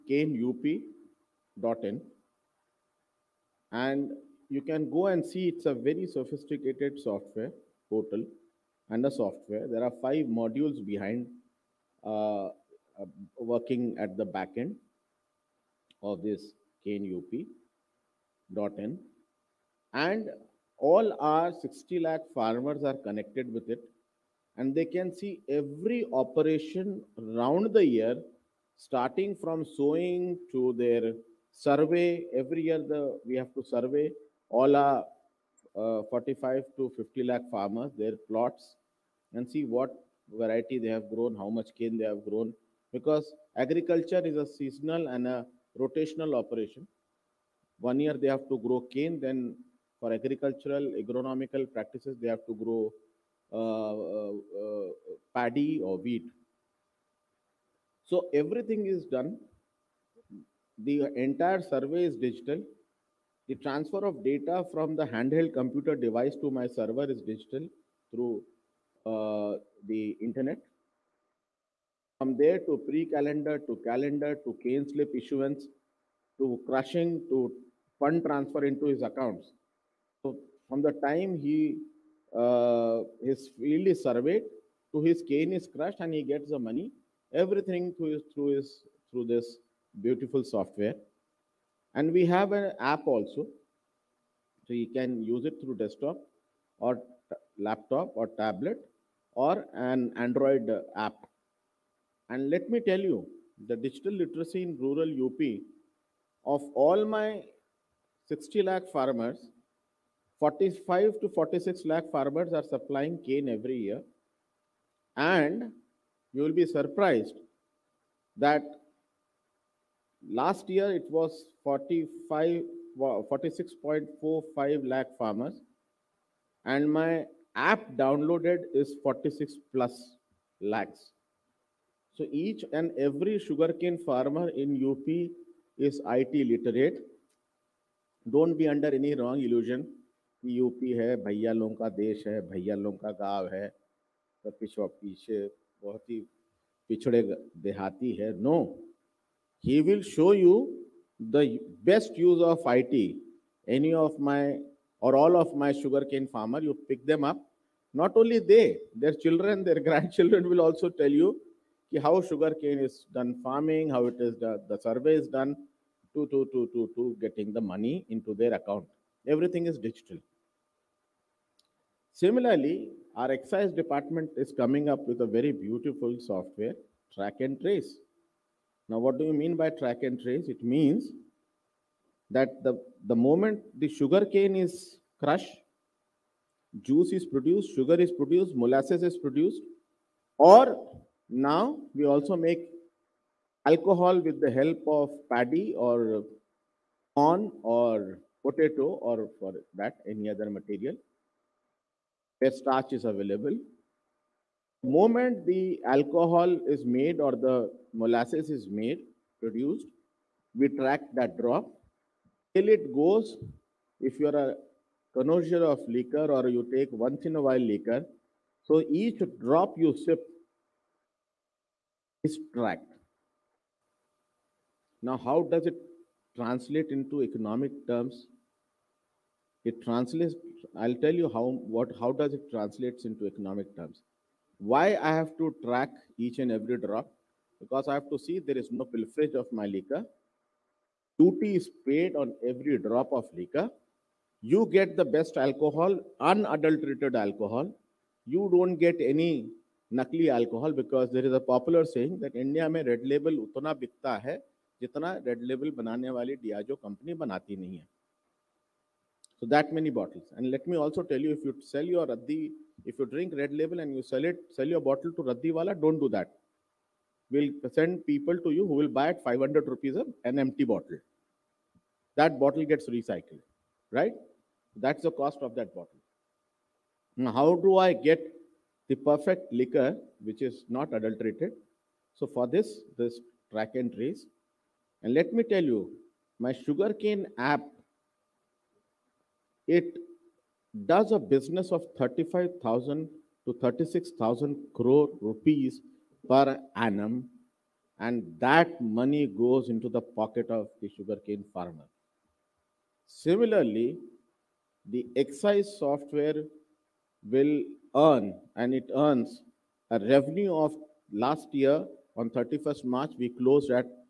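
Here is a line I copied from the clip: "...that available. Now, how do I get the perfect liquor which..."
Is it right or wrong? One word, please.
wrong.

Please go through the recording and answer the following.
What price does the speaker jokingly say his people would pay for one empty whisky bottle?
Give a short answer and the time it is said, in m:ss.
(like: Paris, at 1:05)
500 rupees, at 4:29.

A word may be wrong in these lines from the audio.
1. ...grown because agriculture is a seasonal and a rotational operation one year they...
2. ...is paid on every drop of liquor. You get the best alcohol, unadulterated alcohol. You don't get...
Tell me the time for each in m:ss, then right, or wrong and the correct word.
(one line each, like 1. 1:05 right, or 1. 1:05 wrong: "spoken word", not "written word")
1. 0:42 right
2. 4:01 right.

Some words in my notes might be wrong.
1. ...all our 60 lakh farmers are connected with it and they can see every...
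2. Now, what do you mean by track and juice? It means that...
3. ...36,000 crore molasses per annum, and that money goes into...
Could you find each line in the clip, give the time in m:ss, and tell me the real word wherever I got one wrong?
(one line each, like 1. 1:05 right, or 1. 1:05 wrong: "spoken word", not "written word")
1. 0:20 right
2. 2:58 wrong: "trace", not "juice"
3. 4:53 wrong: "rupees", not "molasses".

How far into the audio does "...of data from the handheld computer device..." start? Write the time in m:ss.
1:04.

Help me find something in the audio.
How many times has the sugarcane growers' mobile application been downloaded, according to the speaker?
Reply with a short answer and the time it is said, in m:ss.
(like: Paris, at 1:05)
46 lakh, at 2:09.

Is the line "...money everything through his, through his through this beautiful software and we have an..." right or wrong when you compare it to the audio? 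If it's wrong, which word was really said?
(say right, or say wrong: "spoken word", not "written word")
right.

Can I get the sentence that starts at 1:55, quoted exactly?
And you will be surprised that last year it was 45, 46.45 lakh farmers.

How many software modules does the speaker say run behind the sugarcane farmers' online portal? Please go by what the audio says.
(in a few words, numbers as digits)
5.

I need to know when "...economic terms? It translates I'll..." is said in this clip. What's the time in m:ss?
3:47.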